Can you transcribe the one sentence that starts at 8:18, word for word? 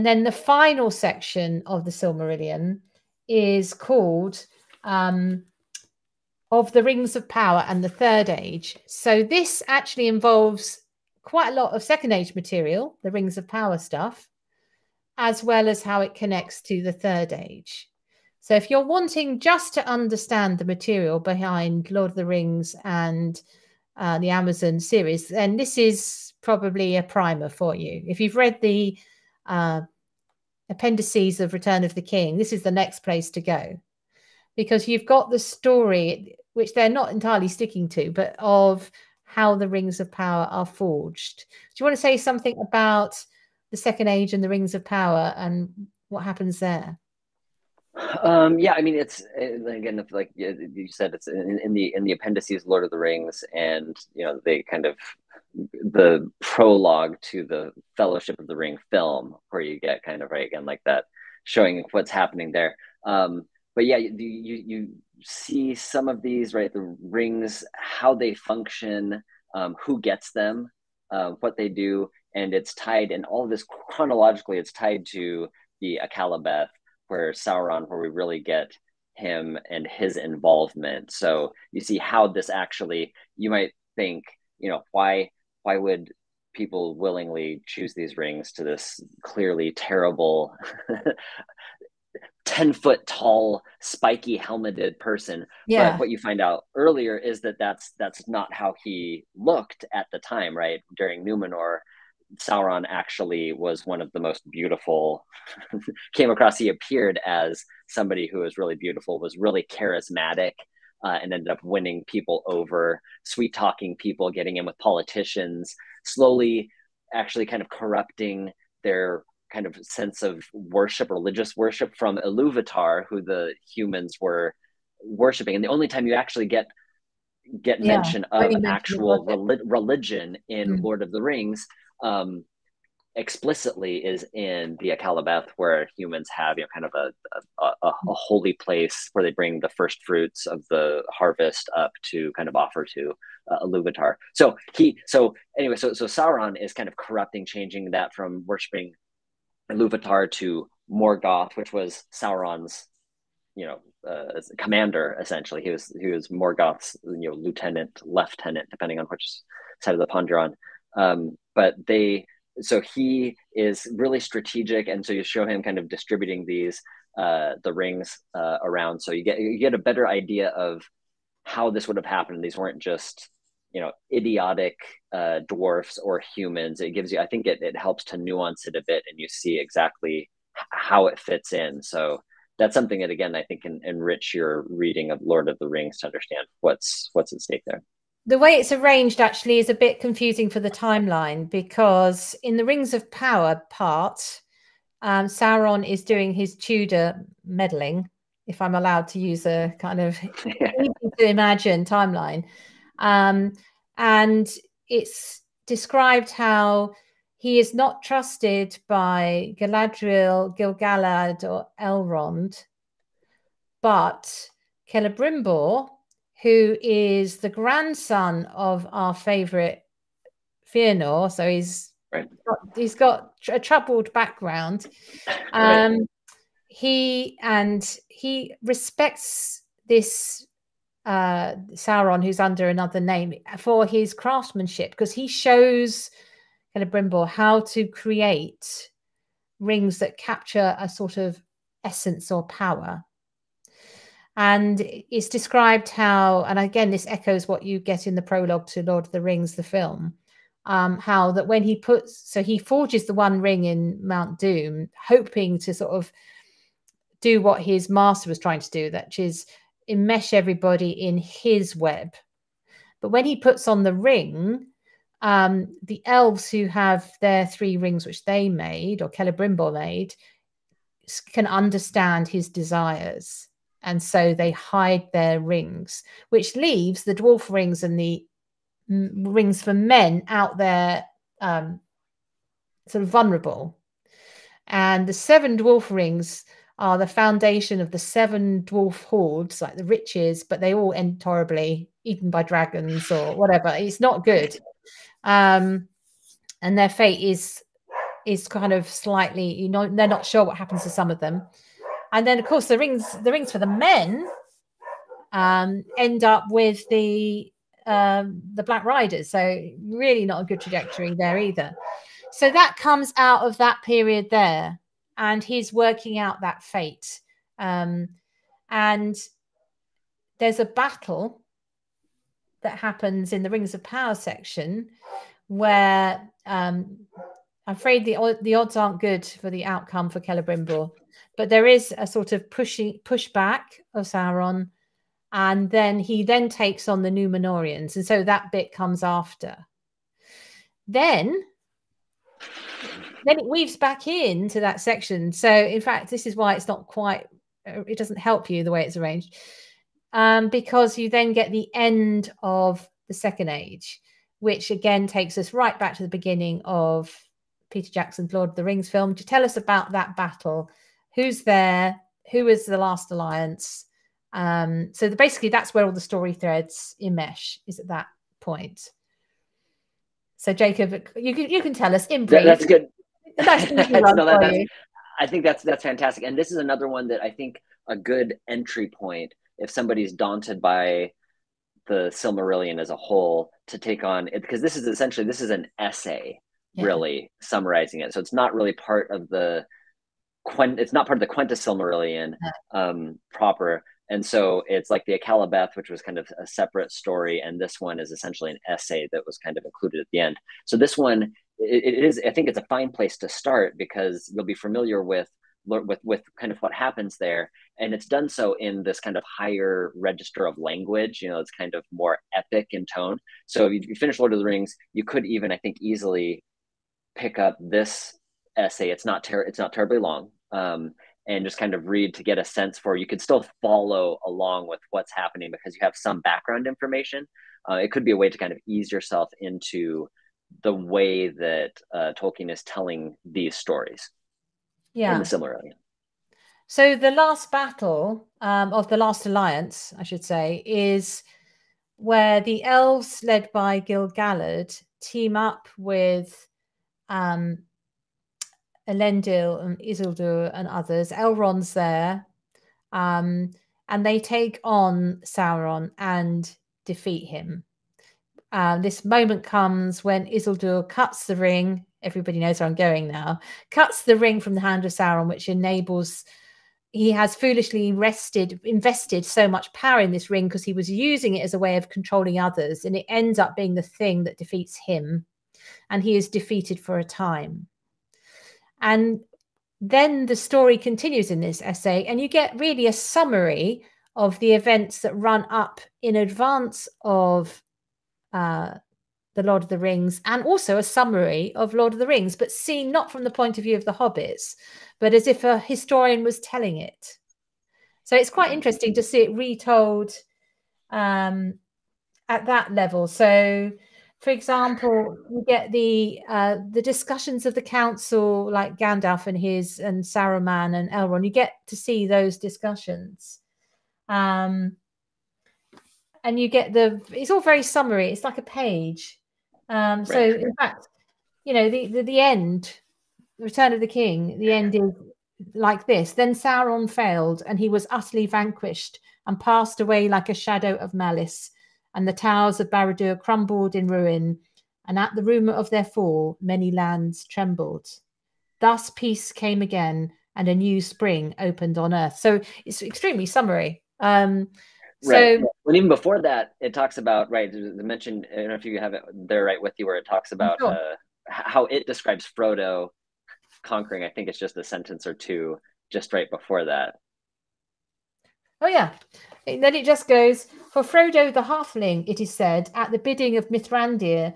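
So it's quite interesting to see it retold um, at that level.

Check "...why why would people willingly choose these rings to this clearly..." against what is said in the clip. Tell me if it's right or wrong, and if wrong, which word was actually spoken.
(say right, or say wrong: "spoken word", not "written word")
right.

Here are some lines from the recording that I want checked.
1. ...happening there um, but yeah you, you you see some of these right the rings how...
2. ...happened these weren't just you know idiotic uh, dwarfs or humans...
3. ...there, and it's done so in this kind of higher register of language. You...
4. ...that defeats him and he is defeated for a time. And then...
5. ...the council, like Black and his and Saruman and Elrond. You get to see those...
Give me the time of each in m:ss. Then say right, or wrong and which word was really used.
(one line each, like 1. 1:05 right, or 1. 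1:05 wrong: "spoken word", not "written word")
1. 1:02 right
2. 2:52 right
3. 6:47 right
4. 7:54 right
5. 8:27 wrong: "Gandalf", not "Black".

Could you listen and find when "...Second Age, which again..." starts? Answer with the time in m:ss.
5:53.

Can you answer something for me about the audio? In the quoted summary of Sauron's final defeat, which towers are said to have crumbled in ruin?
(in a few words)
Baradur.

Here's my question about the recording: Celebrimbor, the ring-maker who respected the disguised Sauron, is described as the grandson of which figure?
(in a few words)
Feanor.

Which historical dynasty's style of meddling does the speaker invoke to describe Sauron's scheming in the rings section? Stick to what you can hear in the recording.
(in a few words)
Tudor.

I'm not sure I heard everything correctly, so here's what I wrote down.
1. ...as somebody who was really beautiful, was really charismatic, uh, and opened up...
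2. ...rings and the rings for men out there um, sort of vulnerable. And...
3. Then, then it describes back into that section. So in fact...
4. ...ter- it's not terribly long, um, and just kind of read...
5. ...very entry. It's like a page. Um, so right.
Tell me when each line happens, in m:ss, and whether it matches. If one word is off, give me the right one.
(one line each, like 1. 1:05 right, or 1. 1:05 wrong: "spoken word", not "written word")
1. 1:47 wrong: "ended", not "opened"
2. 4:37 right
3. 5:40 wrong: "weaves", not "describes"
4. 6:59 right
5. 8:37 wrong: "summary", not "entry".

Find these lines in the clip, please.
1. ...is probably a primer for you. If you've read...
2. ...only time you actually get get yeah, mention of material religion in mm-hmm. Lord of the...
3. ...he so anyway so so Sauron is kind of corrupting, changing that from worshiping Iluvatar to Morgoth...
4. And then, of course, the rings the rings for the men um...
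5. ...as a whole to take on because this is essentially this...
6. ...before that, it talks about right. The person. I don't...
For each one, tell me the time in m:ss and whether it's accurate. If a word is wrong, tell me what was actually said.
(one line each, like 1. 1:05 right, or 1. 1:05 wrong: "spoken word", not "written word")
1. 0:25 right
2. 2:05 wrong: "actual", not "material"
3. 2:24 right
4. 5:02 right
5. 6:22 right
6. 9:05 wrong: "mention", not "person".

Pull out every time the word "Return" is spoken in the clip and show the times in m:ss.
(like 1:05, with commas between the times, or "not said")
0:31, 8:43.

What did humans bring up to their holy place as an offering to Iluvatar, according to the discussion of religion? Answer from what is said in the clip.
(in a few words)
first fruits of the harvest.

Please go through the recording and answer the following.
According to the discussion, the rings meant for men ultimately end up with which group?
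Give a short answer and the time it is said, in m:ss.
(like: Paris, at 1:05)
the Black Riders, at 5:08.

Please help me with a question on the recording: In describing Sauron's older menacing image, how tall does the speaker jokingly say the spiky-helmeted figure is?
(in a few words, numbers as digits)
10 foot.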